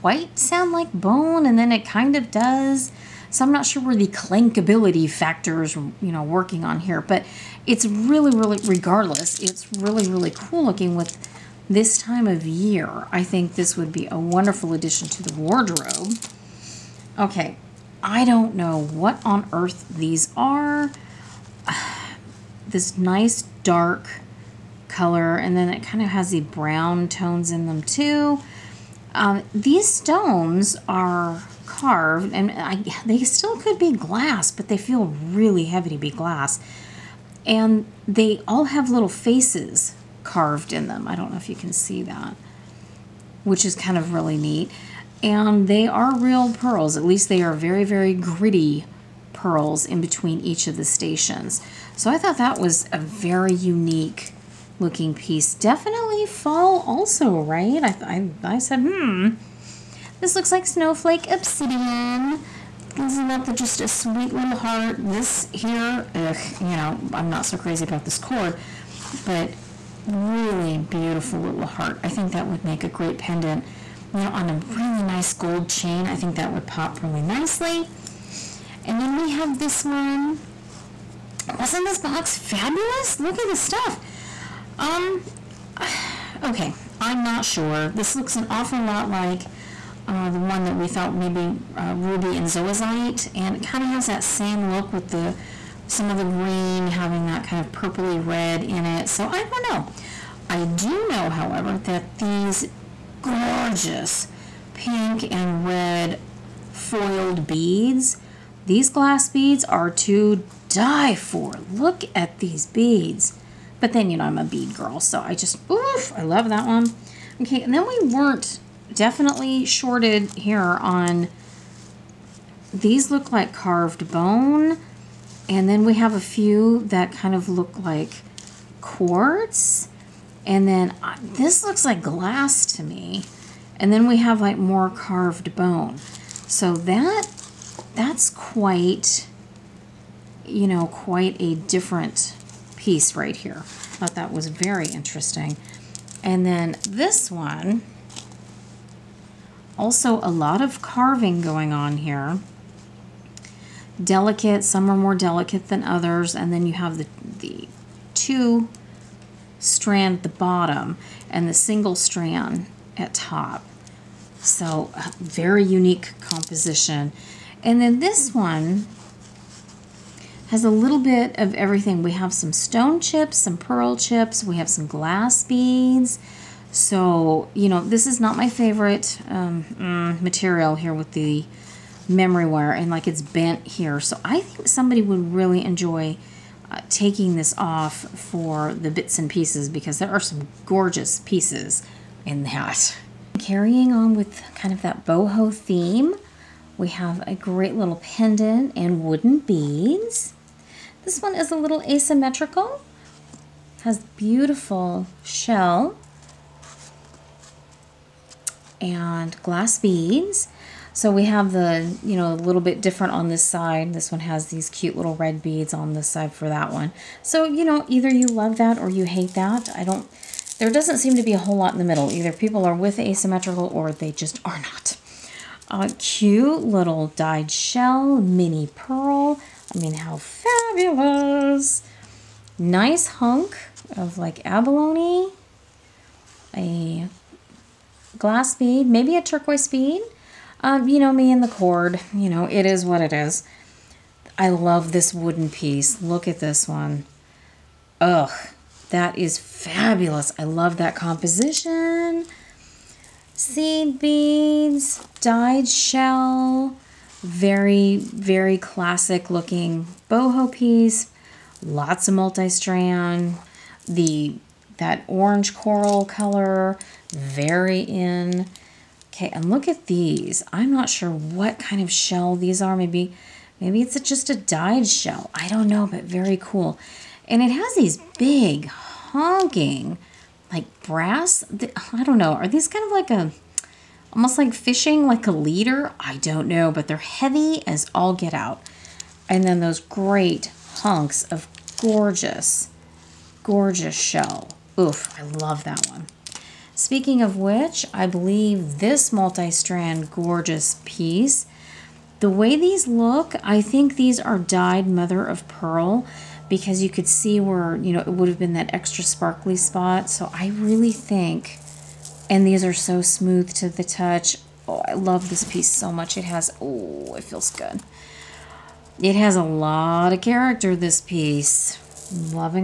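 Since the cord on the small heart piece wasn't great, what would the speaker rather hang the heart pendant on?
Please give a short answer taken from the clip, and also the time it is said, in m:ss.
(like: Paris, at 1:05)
gold chain, at 1:15.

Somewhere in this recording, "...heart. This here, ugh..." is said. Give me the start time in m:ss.
1:04.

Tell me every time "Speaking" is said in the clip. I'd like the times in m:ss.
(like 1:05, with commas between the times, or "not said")
4:56.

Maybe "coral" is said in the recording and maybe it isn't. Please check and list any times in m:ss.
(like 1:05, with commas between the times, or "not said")
4:25.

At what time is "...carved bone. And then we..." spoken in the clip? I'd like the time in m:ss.
2:03.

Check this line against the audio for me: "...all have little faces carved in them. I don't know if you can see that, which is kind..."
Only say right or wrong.
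right.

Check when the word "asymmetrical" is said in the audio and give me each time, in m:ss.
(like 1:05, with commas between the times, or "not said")
3:21, 3:42.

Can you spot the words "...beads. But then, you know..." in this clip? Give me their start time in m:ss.
1:52.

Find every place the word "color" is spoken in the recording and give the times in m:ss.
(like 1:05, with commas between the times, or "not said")
0:24, 4:26.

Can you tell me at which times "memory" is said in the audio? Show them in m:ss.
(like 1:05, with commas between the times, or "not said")
3:02.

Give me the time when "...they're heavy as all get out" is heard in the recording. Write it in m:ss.
4:46.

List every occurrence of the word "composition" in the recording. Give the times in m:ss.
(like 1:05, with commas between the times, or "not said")
2:46, 4:10.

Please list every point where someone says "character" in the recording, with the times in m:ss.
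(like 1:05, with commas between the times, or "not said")
5:20.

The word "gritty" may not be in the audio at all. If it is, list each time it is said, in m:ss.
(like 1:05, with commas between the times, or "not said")
0:48.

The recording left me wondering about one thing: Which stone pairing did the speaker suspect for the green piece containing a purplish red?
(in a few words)
ruby and zoisite.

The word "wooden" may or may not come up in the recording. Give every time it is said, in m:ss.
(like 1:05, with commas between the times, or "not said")
3:19, 4:05.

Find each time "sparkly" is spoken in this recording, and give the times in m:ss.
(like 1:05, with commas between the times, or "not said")
5:09.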